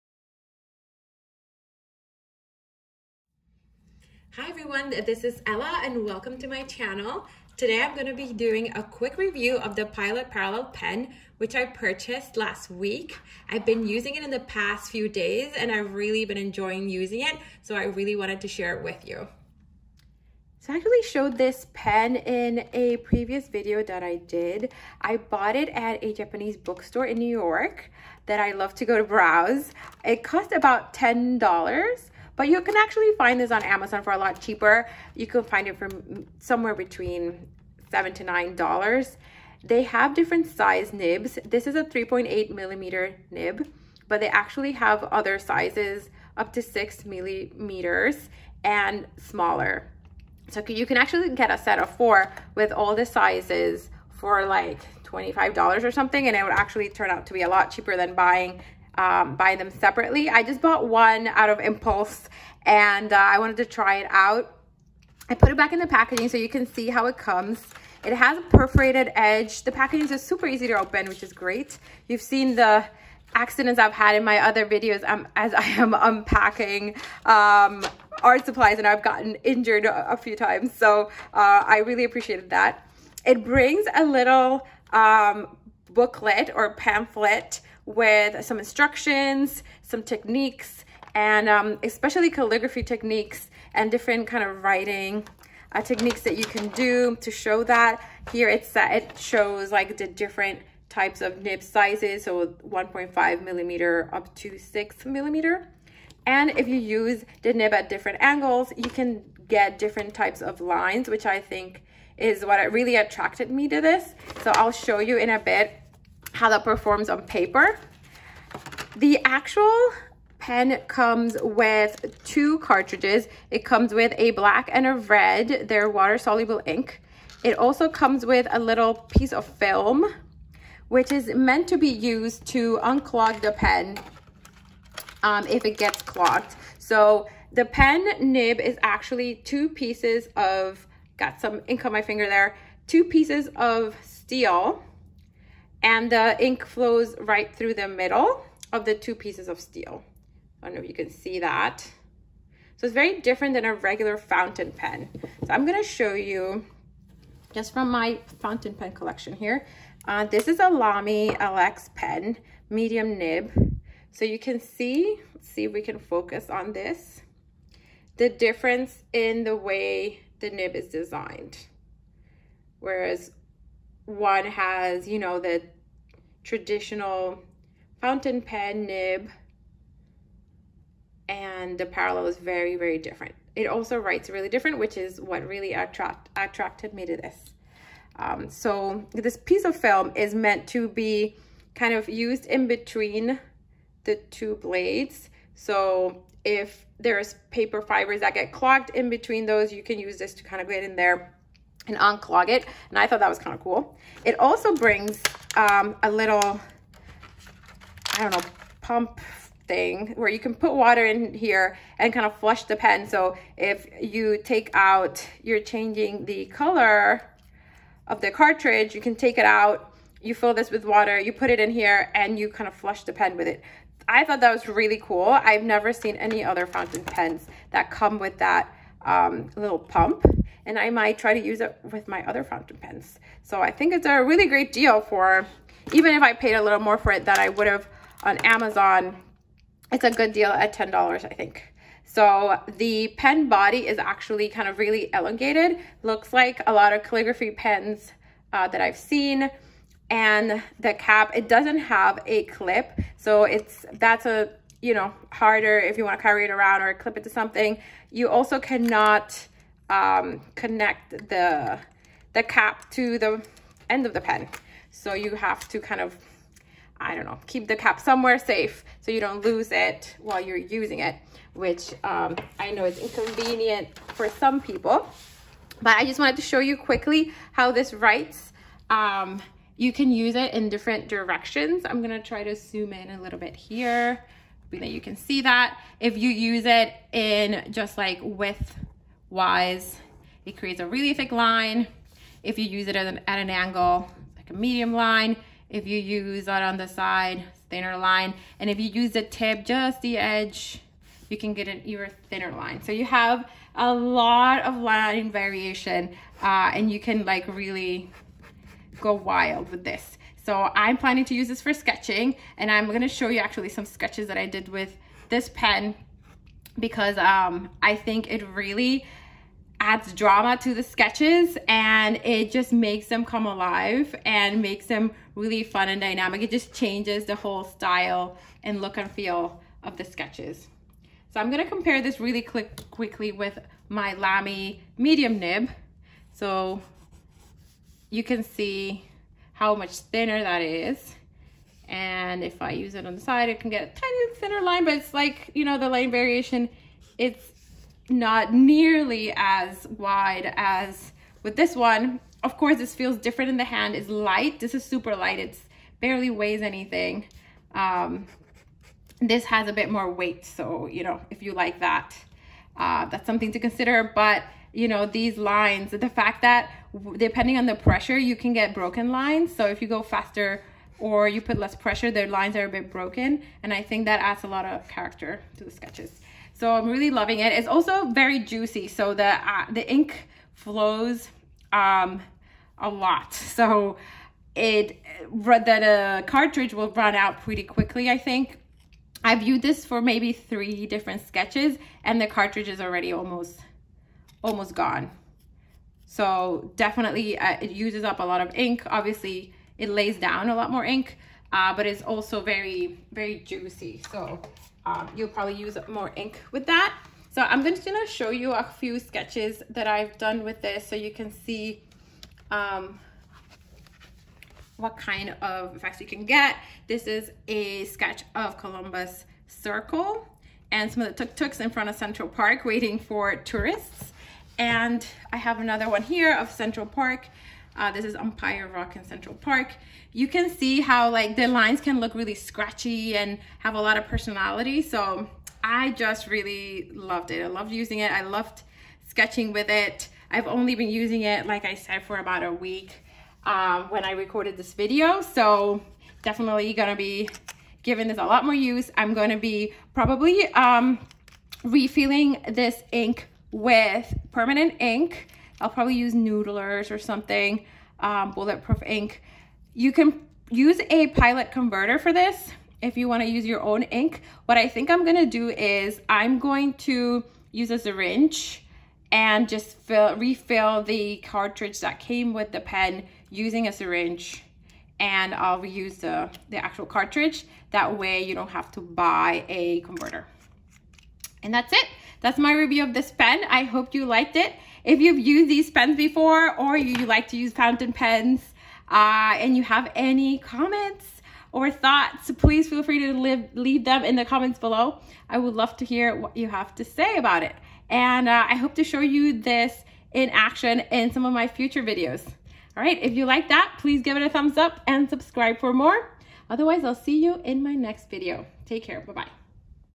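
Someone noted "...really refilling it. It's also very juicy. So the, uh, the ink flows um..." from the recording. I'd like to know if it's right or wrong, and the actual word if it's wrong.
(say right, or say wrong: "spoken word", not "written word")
wrong: "loving", not "refilling".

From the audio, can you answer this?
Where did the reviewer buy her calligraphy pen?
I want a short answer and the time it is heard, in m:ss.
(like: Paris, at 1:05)
Japanese bookstore in New York, at 0:26.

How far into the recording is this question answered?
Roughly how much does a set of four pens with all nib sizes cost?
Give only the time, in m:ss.
0:55.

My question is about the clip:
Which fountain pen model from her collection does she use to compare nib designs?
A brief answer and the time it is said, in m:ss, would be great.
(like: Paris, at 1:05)
Lamy LX, at 2:40.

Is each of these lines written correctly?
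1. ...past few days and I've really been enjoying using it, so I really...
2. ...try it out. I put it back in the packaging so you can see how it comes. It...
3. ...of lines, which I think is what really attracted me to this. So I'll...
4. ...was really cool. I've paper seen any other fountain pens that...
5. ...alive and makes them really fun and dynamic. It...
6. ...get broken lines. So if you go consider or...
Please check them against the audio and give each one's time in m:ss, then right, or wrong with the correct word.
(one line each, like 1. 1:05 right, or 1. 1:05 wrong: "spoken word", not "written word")
1. 0:14 right
2. 1:03 right
3. 1:50 right
4. 3:44 wrong: "never", not "paper"
5. 5:23 right
6. 6:08 wrong: "faster", not "consider".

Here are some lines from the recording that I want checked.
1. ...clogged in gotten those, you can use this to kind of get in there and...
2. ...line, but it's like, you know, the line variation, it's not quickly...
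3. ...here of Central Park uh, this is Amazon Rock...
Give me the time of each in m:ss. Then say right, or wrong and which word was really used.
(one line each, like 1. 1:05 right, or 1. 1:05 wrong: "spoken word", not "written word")
1. 3:18 wrong: "between", not "gotten"
2. 5:44 wrong: "nearly", not "quickly"
3. 7:06 wrong: "Umpire", not "Amazon".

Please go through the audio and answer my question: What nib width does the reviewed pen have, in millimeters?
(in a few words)
3.8.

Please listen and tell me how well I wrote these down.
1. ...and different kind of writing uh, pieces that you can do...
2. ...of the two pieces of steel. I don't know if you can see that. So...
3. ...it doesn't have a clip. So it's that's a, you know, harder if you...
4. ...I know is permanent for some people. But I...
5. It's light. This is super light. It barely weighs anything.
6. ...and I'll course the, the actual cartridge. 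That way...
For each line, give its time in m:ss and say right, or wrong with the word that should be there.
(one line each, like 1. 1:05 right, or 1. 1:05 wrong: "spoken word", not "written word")
1. 1:33 wrong: "techniques", not "pieces"
2. 2:28 right
3. 4:11 right
4. 4:32 wrong: "inconvenient", not "permanent"
5. 5:53 right
6. 7:54 wrong: "reuse", not "course".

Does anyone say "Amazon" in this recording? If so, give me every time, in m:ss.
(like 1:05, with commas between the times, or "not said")
0:33, 3:58.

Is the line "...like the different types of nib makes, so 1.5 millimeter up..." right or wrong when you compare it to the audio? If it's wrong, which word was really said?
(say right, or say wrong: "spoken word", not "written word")
wrong: "sizes", not "makes".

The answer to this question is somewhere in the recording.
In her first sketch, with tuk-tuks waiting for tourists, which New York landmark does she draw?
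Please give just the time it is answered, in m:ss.
6:58.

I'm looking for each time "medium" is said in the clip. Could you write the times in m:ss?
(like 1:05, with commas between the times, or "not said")
2:42, 4:54, 5:34.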